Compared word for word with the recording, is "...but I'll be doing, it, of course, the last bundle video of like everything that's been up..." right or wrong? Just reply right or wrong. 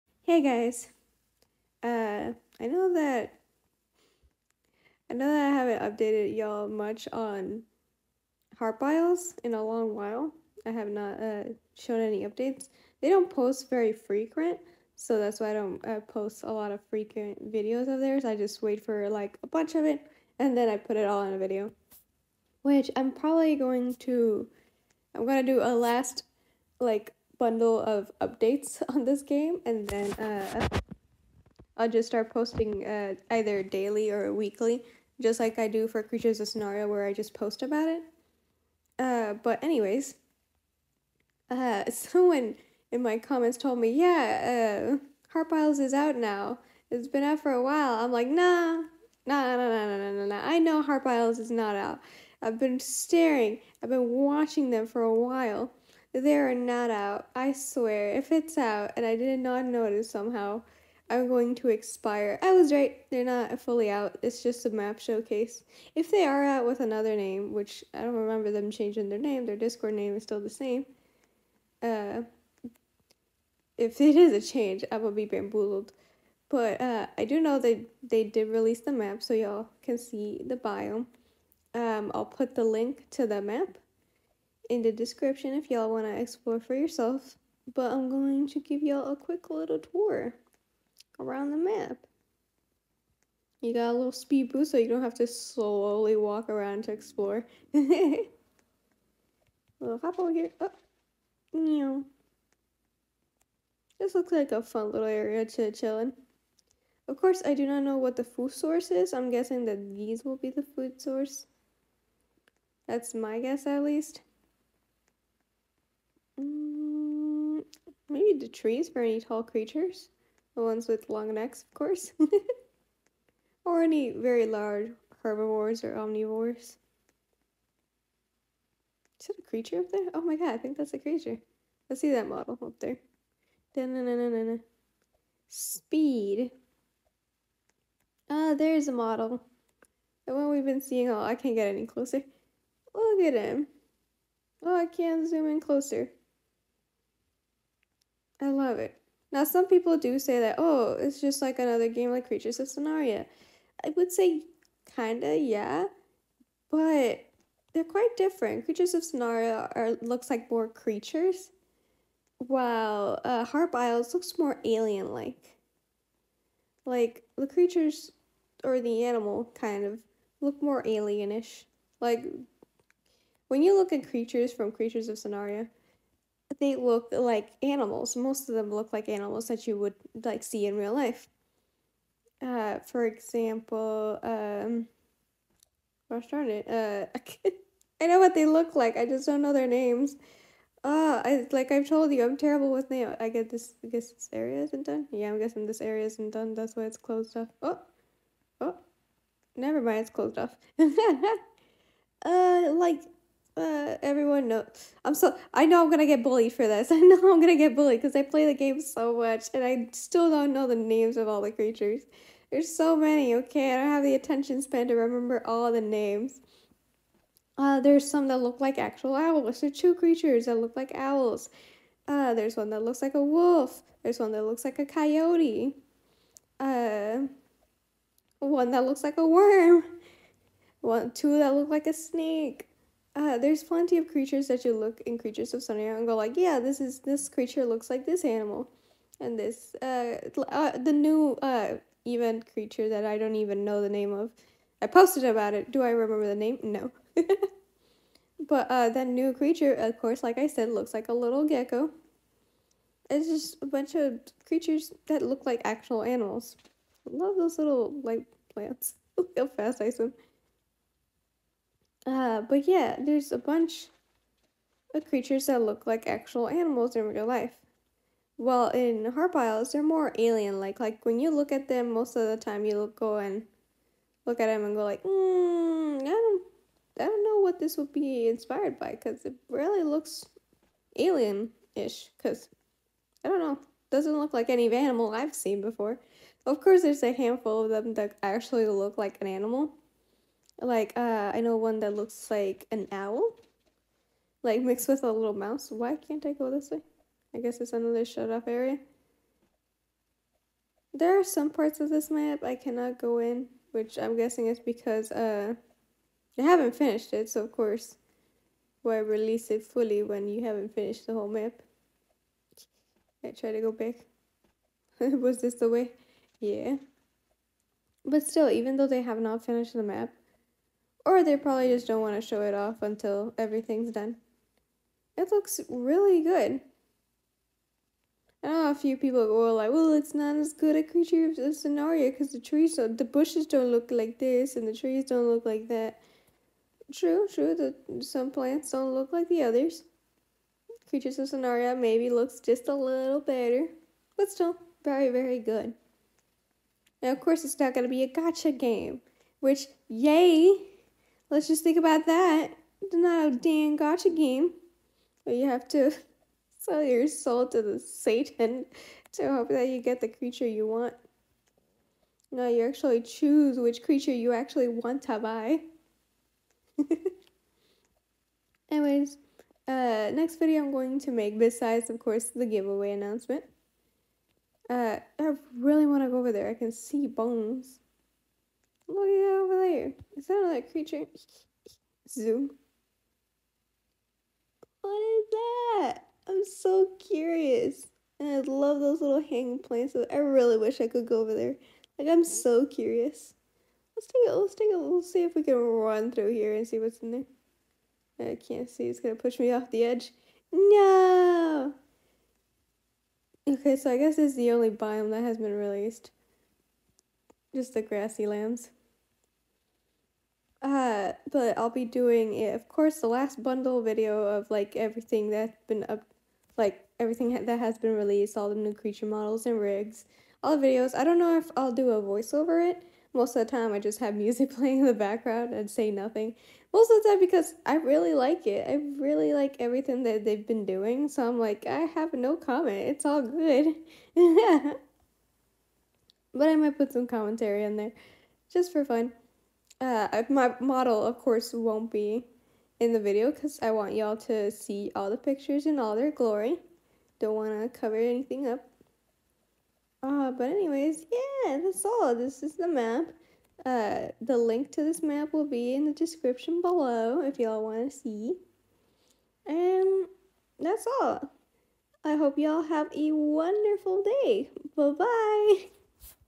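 right.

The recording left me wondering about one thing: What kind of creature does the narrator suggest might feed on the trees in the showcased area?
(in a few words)
Ones with long necks.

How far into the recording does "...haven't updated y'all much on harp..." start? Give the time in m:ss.
0:05.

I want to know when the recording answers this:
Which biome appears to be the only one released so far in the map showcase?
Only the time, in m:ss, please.
6:47.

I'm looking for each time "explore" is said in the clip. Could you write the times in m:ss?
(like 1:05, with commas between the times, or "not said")
1:26, 1:36.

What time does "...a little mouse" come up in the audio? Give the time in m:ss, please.
4:55.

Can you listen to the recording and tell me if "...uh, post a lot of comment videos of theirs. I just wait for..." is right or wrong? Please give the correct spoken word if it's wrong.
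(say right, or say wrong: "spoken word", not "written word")
wrong: "frequent", not "comment".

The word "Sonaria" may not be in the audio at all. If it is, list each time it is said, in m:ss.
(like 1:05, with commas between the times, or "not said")
0:36, 2:32, 2:39, 2:55, 3:55, 5:31, 5:41.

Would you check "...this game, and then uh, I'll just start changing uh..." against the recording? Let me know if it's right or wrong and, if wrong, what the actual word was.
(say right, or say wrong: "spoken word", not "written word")
wrong: "posting", not "changing".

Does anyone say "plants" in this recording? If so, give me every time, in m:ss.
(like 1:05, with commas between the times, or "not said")
4:18, 5:38, 6:29.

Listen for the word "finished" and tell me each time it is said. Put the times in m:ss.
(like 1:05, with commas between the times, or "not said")
5:06, 5:10, 5:19.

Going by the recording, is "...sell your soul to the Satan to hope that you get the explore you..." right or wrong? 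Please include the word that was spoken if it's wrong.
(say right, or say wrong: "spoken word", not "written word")
wrong: "creature", not "explore".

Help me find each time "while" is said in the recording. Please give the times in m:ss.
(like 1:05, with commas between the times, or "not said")
0:09, 0:47, 0:55, 2:42, 4:28.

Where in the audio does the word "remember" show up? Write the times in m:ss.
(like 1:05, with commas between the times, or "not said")
1:08, 3:34, 4:05.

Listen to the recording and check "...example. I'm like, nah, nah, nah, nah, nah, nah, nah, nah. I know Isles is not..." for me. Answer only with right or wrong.
wrong.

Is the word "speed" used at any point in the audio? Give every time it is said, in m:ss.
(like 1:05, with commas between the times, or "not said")
1:34, 2:15.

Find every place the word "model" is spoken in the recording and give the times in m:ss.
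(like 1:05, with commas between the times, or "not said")
2:12, 2:19, 6:59, 7:20.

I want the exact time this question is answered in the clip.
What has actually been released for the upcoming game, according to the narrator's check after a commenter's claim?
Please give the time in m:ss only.
1:04.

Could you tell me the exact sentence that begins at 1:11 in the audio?
Uh, if it is a change, I will be bamboozled.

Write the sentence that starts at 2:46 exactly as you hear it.
Like the creatures or the animal kind of look more alienish.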